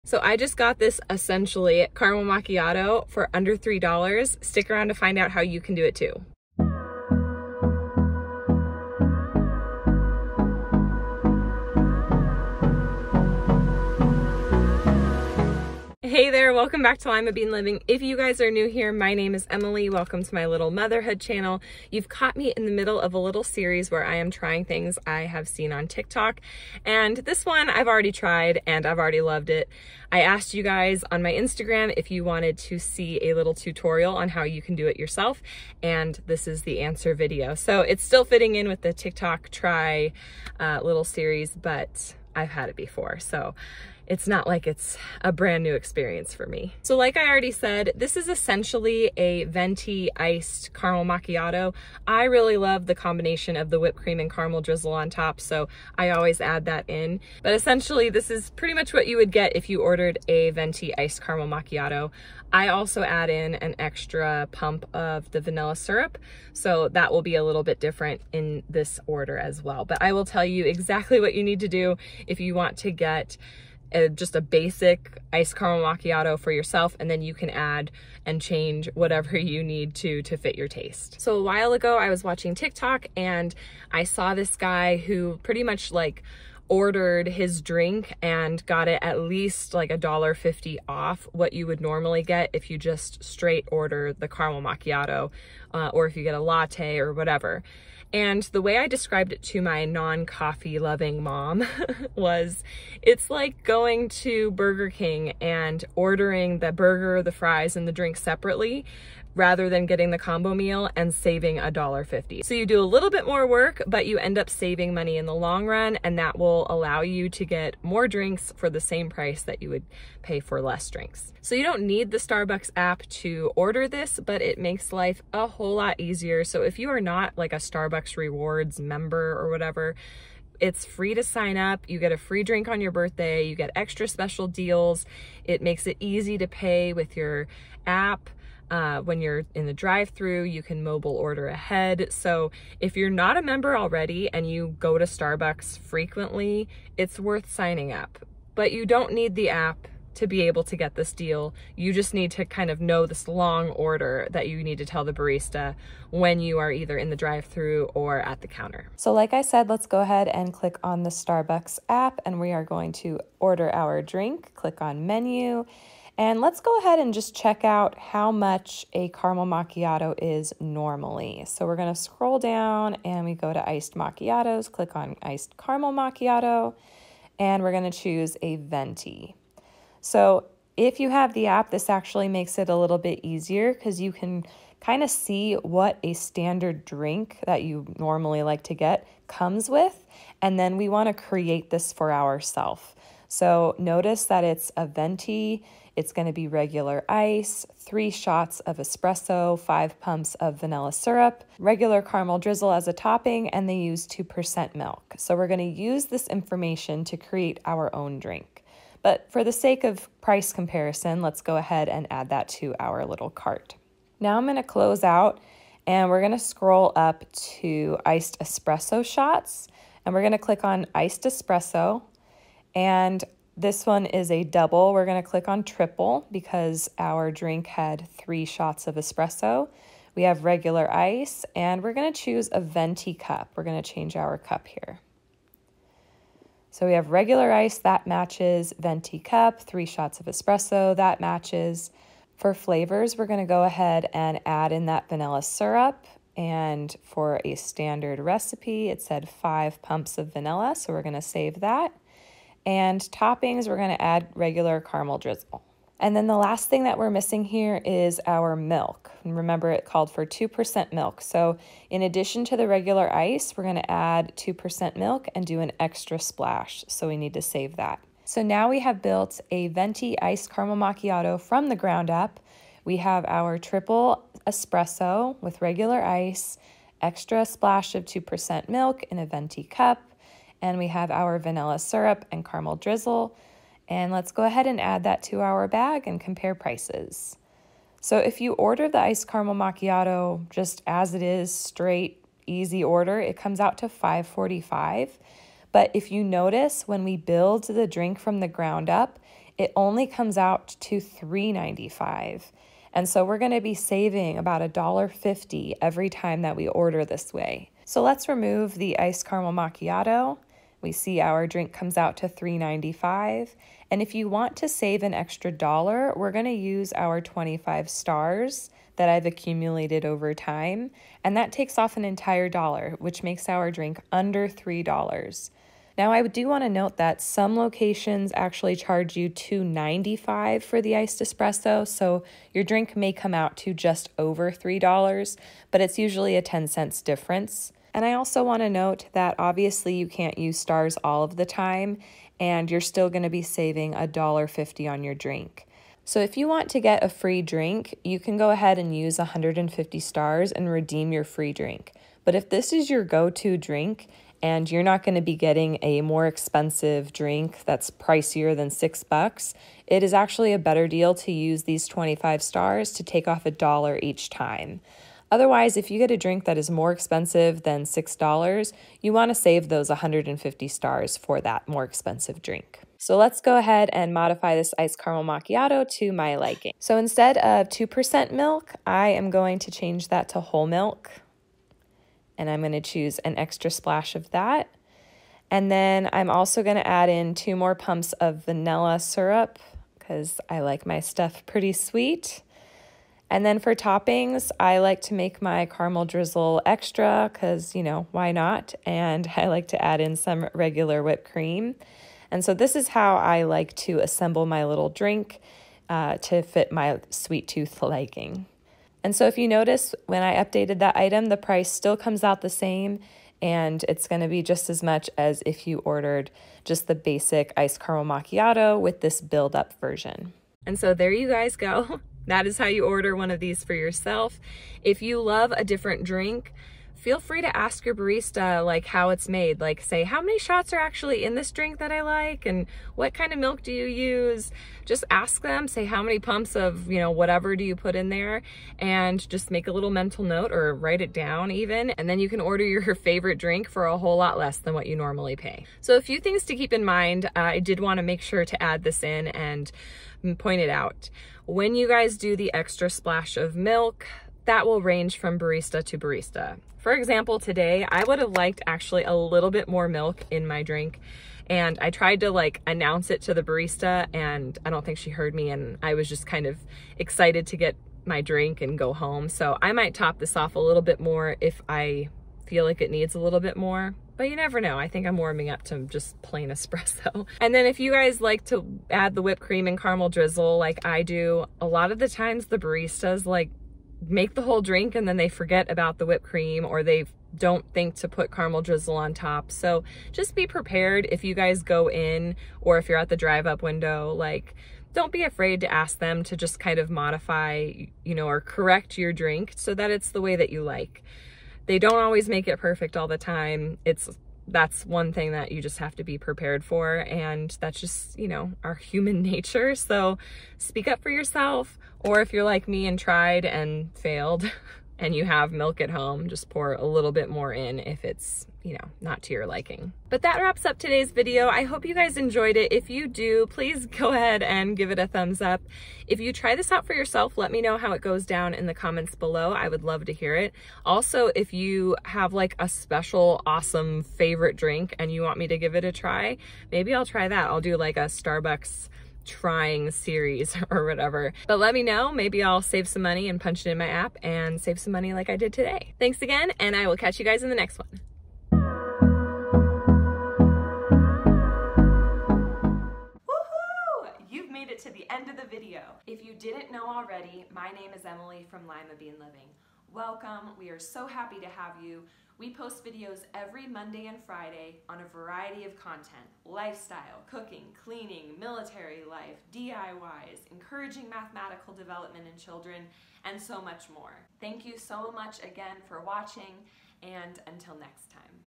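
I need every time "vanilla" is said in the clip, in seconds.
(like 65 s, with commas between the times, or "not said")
65 s, 200 s, 245 s, 250 s, 281 s, 388 s.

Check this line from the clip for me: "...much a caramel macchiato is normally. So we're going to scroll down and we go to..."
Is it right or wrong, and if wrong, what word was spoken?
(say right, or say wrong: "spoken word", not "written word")
right.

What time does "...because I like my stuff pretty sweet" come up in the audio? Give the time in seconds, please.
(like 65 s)
389 s.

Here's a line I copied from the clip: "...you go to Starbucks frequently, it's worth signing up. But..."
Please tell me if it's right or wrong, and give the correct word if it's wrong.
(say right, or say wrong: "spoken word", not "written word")
right.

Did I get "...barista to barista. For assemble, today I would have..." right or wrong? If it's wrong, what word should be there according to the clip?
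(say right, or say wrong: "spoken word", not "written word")
wrong: "example", not "assemble".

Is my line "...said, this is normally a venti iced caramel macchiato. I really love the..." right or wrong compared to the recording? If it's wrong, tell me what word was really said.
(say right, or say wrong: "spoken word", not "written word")
wrong: "essentially", not "normally".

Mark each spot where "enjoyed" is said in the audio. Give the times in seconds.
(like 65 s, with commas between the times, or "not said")
522 s.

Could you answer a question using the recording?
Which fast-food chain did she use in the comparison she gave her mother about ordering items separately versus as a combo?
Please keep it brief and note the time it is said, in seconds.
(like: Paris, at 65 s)
Burger King, at 104 s.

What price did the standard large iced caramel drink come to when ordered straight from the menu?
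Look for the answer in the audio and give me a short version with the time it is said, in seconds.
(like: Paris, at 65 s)
$5.45, at 293 s.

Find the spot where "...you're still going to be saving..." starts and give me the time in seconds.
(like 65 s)
342 s.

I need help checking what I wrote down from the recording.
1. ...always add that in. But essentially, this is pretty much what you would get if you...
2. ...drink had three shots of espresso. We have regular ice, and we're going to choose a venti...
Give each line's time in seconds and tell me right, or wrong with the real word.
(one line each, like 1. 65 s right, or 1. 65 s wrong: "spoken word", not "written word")
1. 56 s right
2. 227 s right.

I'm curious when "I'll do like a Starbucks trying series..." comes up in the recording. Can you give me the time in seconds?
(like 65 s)
537 s.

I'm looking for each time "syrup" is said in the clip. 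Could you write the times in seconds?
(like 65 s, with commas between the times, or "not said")
65 s, 200 s, 245 s, 281 s, 388 s.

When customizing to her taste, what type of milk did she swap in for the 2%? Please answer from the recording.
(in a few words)
Whole milk.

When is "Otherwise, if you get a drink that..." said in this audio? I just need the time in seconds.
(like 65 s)
365 s.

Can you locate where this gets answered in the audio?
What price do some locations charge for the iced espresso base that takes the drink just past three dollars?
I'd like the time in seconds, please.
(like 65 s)
329 s.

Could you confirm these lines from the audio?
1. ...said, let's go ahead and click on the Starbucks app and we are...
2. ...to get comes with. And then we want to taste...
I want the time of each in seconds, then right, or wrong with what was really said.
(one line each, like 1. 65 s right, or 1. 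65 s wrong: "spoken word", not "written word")
1. 159 s right
2. 188 s wrong: "create", not "taste".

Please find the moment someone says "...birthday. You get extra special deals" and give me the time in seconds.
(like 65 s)
132 s.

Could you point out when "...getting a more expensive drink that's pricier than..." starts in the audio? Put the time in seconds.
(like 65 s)
355 s.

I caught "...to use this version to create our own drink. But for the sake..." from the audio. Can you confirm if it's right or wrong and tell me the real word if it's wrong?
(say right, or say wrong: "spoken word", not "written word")
wrong: "information", not "version".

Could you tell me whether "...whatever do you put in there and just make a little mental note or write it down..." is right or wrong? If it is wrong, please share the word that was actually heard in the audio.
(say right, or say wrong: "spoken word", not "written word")
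right.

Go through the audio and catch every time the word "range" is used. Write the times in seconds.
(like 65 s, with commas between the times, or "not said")
454 s.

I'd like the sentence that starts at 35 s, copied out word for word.
And this is the answer video.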